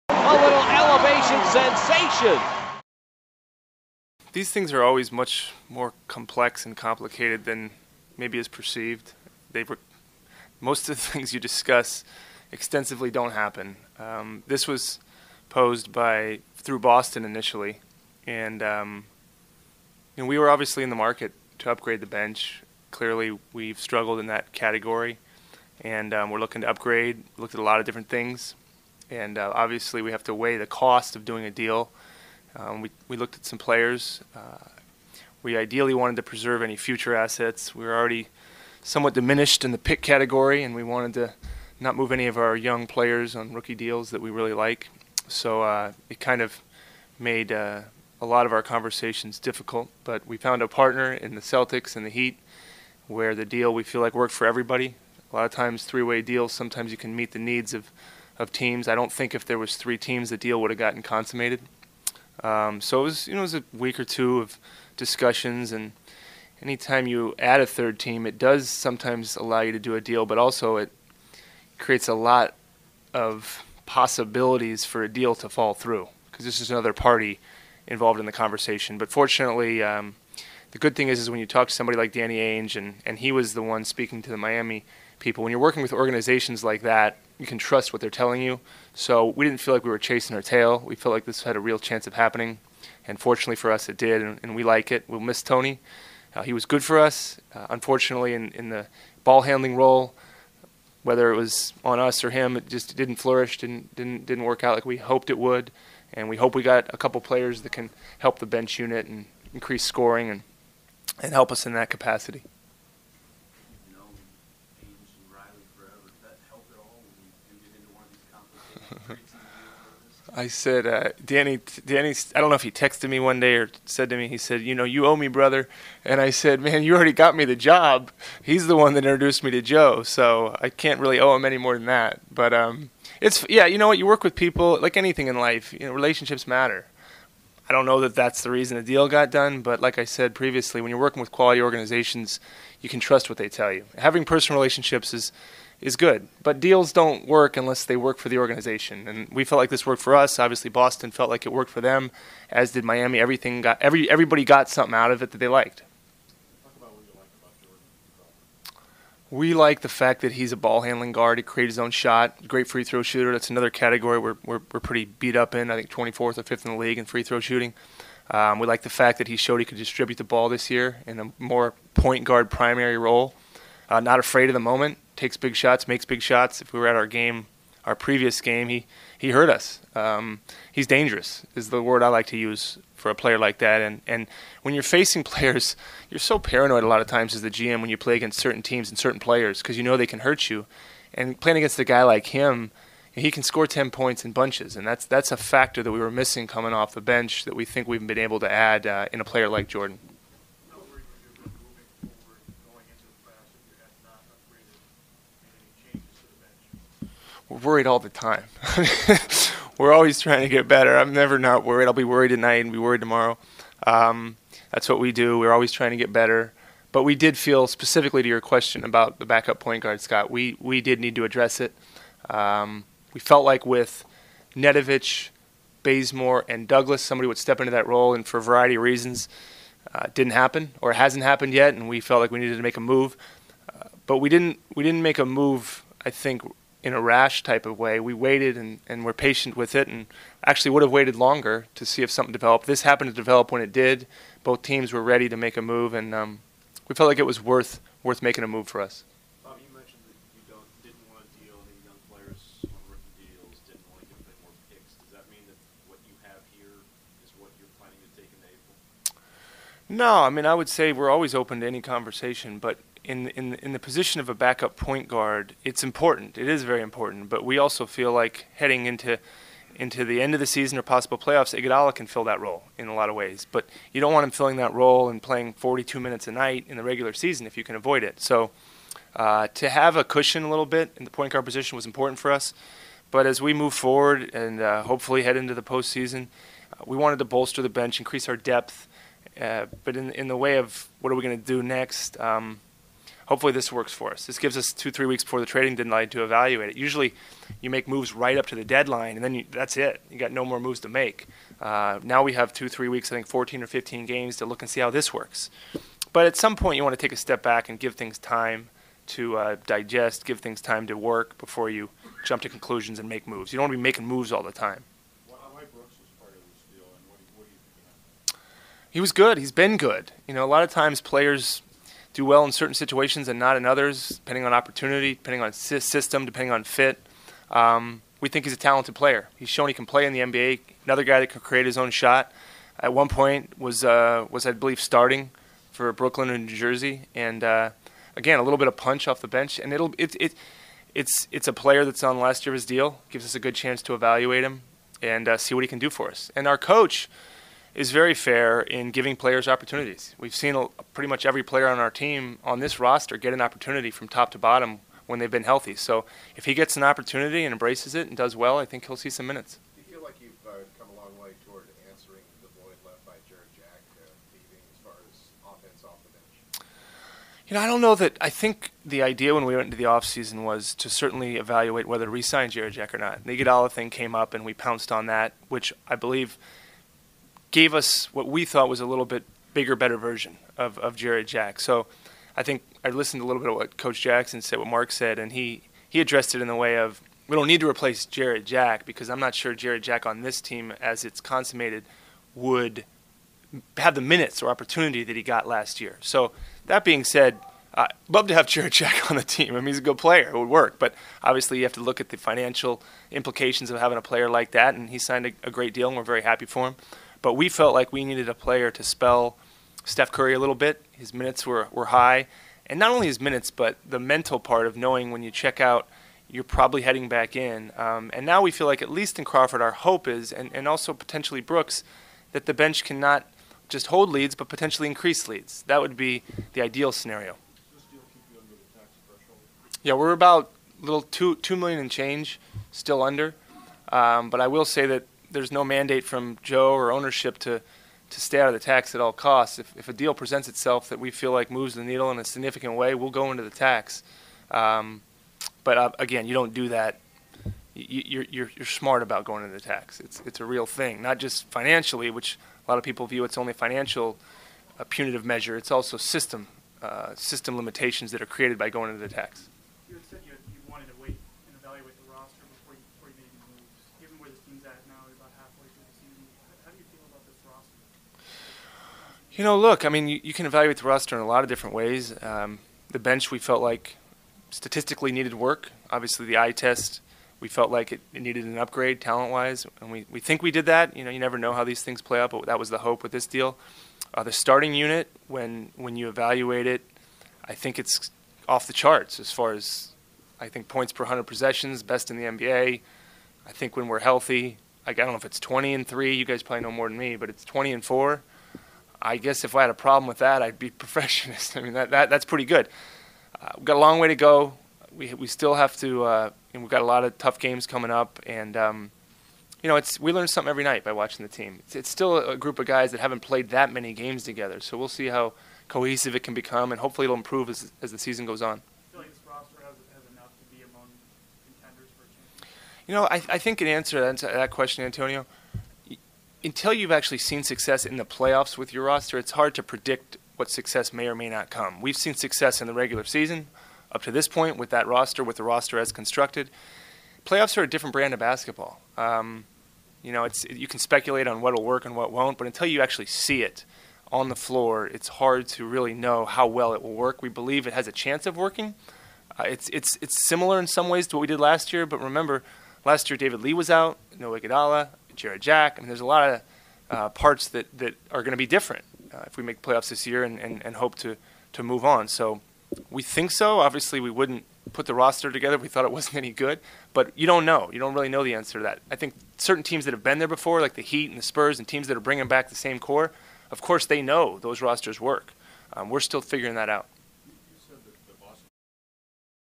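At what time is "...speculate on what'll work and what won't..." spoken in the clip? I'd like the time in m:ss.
9:00.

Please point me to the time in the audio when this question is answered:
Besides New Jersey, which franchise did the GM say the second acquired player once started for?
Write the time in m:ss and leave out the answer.
5:35.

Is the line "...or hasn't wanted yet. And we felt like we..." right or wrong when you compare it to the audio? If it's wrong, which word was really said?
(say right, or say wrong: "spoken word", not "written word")
wrong: "happened", not "wanted".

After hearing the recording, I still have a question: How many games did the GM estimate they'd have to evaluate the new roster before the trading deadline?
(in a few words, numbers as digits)
14 or 15.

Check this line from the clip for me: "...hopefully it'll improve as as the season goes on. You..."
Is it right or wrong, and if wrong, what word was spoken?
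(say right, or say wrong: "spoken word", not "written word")
right.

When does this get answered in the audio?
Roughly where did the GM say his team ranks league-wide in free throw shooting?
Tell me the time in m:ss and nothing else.
2:45.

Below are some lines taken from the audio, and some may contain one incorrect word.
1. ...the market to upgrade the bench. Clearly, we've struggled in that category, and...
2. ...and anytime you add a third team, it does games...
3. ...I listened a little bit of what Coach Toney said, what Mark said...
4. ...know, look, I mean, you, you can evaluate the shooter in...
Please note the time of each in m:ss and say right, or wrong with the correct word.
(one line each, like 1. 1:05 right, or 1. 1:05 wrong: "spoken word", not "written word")
1. 0:20 right
2. 1:05 wrong: "sometimes", not "games"
3. 6:22 wrong: "Jackson", not "Toney"
4. 7:49 wrong: "roster", not "shooter".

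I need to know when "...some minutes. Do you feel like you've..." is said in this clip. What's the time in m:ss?
5:59.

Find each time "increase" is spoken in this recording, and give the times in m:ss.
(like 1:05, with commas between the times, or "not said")
1:49, 4:47, 7:04.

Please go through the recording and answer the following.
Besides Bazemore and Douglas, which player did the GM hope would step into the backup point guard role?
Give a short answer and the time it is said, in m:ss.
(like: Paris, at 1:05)
Nedovic, at 3:44.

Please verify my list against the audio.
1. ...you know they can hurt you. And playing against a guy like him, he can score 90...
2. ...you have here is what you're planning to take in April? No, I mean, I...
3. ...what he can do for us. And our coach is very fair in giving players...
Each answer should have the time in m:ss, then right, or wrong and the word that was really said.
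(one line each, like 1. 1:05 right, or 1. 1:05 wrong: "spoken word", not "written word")
1. 3:09 wrong: "10", not "90"
2. 4:16 right
3. 5:45 right.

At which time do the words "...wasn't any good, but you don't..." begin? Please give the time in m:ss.
9:25.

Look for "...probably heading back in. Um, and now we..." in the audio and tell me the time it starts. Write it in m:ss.
6:56.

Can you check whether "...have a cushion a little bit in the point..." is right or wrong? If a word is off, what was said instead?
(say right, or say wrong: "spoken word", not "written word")
right.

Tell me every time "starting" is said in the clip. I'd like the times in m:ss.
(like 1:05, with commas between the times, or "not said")
5:34, 8:04.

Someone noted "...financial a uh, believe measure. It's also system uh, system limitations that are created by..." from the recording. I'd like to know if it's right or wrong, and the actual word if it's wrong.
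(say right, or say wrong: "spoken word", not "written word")
wrong: "punitive", not "believe".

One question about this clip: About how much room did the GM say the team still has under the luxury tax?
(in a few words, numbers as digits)
2 million.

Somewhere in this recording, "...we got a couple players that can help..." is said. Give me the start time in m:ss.
1:46.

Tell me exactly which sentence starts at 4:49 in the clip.
Uh, but in in the way of what are we going to do next?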